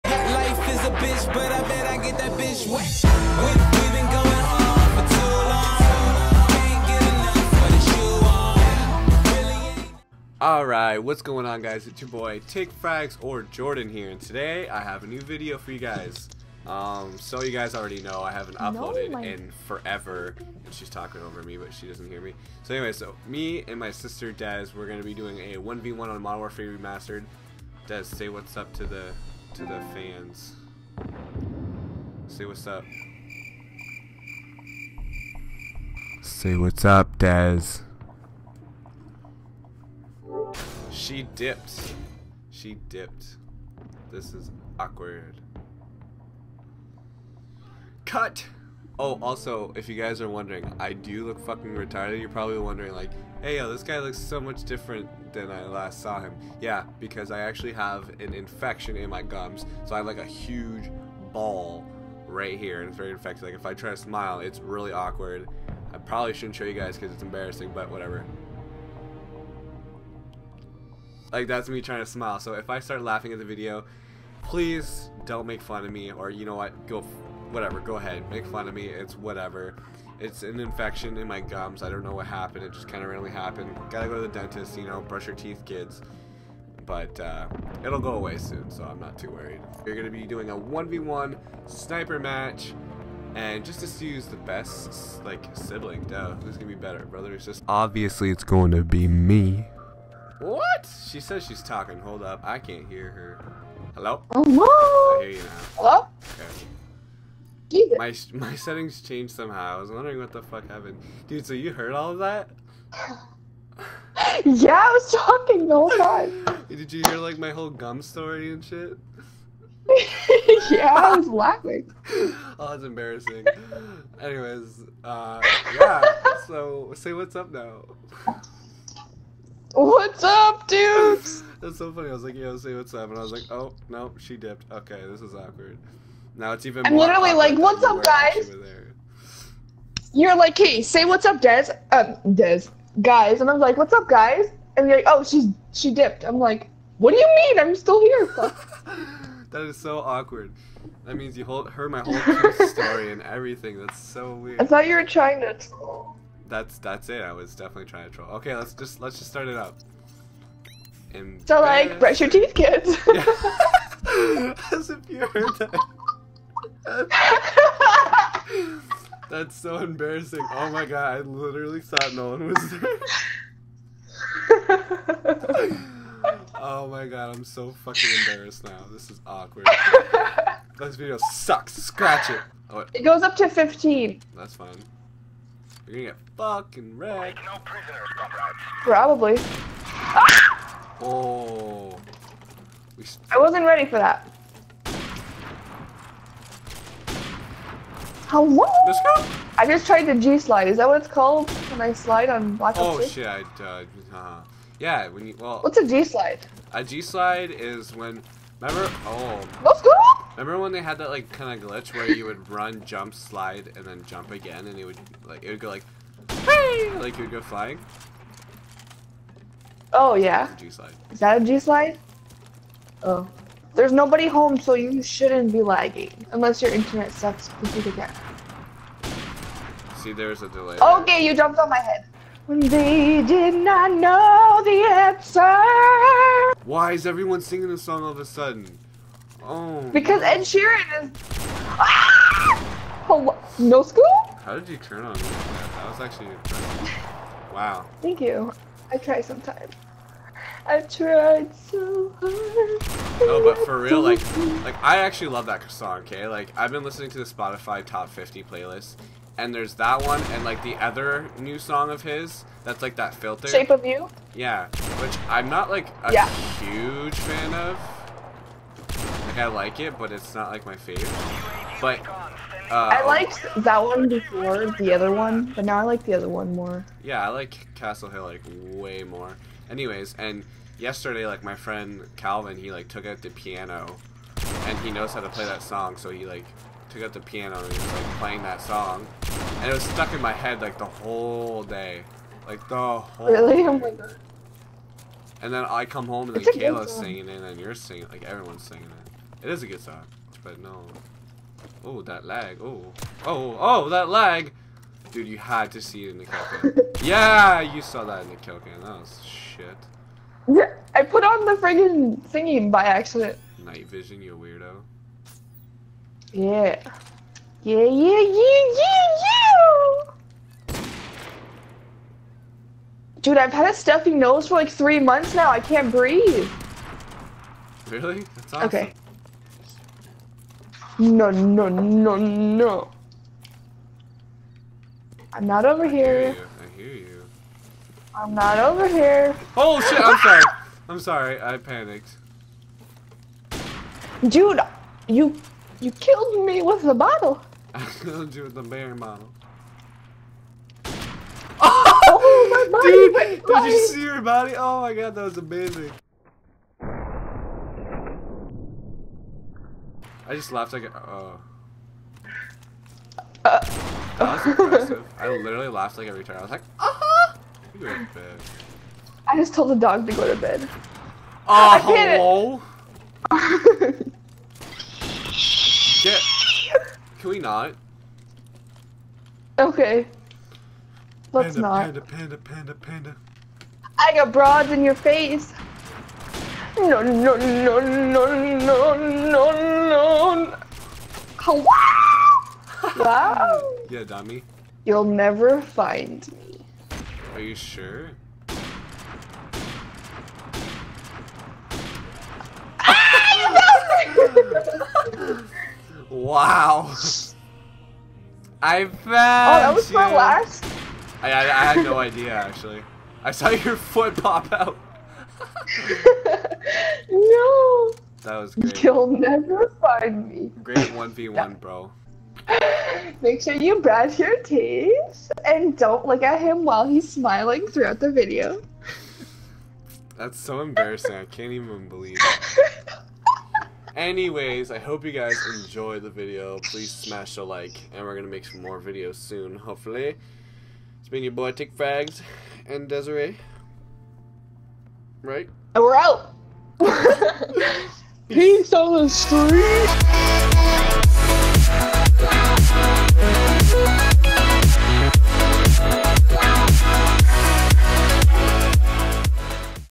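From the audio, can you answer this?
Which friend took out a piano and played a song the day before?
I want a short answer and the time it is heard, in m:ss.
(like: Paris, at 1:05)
Calvin, at 4:42.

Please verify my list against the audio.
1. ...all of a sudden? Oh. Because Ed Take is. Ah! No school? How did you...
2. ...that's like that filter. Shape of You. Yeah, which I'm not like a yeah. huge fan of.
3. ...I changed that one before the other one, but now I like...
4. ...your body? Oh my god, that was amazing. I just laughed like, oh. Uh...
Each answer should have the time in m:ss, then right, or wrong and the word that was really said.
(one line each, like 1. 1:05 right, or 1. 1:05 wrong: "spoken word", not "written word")
1. 3:58 wrong: "Sheeran", not "Take"
2. 4:22 right
3. 4:32 wrong: "liked", not "changed"
4. 5:54 right.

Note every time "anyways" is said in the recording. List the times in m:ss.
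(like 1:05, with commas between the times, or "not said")
0:22, 2:04, 4:39, 7:13.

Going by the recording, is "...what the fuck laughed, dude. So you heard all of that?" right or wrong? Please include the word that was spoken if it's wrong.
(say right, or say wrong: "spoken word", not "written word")
wrong: "happened", not "laughed".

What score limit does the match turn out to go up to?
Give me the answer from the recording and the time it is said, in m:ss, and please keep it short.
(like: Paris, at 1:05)
15, at 3:03.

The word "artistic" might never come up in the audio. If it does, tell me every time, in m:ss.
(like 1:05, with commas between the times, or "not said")
not said.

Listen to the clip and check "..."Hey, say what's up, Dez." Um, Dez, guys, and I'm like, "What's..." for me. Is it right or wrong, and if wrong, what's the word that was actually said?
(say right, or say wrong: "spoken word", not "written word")
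right.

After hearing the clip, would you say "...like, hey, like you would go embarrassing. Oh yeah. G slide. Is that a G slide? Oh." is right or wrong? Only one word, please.
wrong.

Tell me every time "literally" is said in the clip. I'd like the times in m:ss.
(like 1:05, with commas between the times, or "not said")
2:16, 2:51, 6:05.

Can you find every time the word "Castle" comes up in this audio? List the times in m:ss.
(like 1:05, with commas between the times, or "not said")
4:37.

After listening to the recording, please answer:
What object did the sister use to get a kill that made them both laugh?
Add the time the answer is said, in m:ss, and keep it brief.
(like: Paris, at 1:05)
Beer bottle, at 5:48.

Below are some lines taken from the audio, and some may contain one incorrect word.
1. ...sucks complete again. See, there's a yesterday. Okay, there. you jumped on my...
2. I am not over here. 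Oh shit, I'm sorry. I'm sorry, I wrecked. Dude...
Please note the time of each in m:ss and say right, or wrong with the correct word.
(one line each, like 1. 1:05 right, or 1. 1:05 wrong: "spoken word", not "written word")
1. 3:47 wrong: "delay", not "yesterday"
2. 5:38 wrong: "panicked", not "wrecked".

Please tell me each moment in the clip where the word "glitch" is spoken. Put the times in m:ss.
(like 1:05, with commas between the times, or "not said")
3:31.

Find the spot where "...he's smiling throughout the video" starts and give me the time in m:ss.
7:06.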